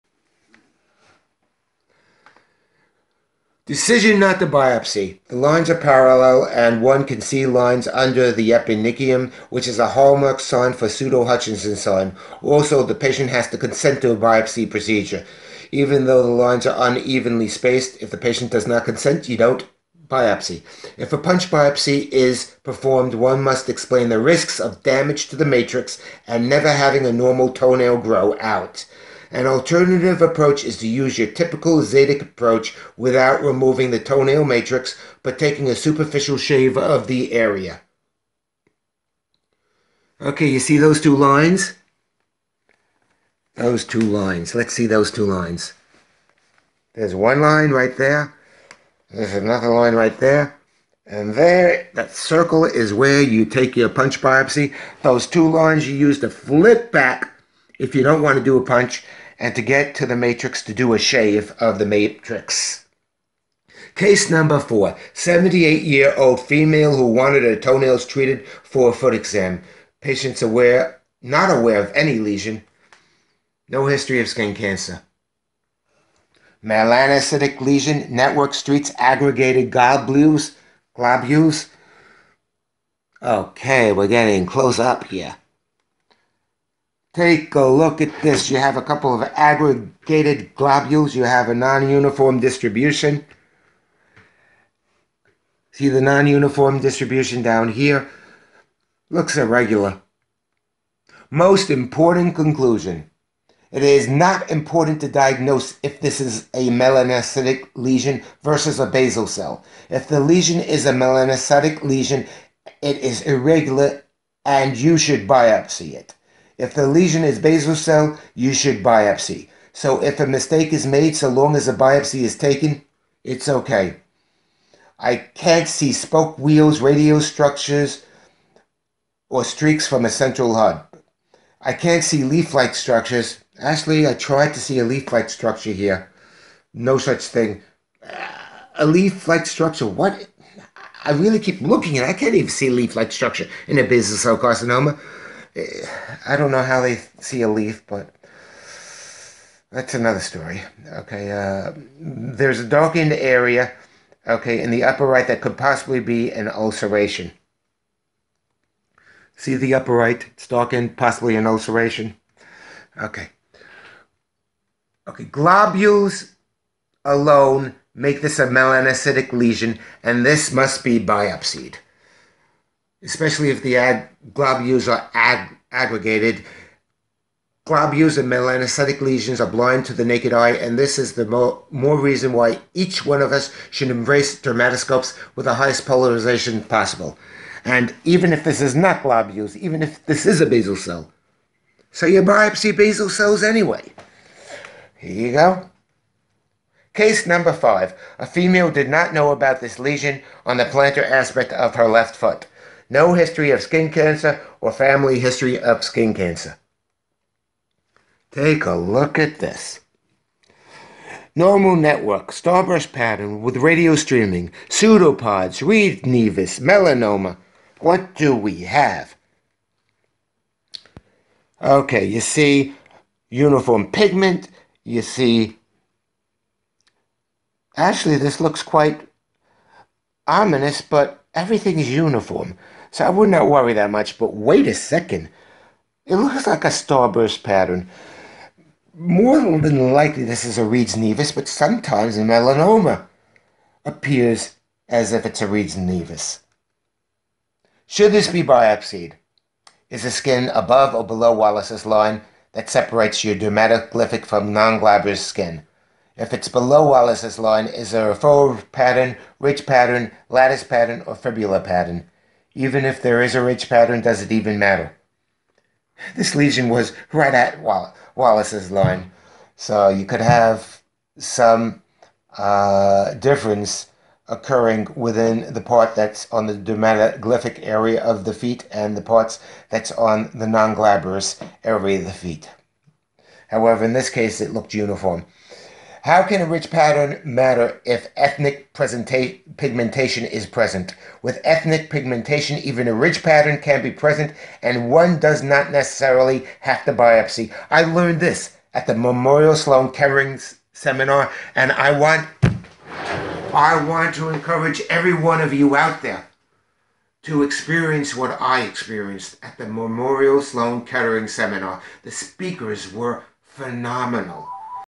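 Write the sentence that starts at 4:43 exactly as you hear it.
However, in this case, it looked uniform.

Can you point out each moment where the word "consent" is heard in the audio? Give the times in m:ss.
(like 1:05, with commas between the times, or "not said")
0:13, 0:18.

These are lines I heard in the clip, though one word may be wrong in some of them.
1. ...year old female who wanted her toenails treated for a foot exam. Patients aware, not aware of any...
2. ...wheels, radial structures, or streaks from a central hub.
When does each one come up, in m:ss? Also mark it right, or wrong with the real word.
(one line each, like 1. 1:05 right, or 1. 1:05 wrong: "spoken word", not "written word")
1. 1:05 right
2. 2:06 right.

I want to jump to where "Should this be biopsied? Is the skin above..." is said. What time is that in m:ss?
4:07.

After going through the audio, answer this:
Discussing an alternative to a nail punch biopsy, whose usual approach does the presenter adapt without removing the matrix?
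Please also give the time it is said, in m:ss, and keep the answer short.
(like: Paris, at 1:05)
Zadik, at 0:31.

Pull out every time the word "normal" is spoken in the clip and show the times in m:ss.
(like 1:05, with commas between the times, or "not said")
0:27, 3:31.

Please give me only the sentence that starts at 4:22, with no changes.
Even if there is a ridge pattern, does it even matter?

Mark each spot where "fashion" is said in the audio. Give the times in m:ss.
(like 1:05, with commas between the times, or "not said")
not said.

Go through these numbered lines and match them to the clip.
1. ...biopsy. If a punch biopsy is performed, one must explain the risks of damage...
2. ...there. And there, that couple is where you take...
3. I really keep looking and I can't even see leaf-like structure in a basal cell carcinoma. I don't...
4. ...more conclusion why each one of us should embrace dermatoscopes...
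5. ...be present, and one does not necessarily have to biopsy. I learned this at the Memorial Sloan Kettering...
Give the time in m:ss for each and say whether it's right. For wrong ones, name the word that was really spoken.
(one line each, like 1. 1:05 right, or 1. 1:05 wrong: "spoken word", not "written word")
1. 0:20 right
2. 0:50 wrong: "circle", not "couple"
3. 2:21 right
4. 3:01 wrong: "reason", not "conclusion"
5. 4:53 right.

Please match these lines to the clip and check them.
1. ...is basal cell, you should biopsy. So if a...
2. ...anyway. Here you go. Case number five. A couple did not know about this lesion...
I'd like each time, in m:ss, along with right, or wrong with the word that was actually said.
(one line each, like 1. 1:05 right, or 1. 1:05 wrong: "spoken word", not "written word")
1. 1:57 right
2. 3:13 wrong: "female", not "couple".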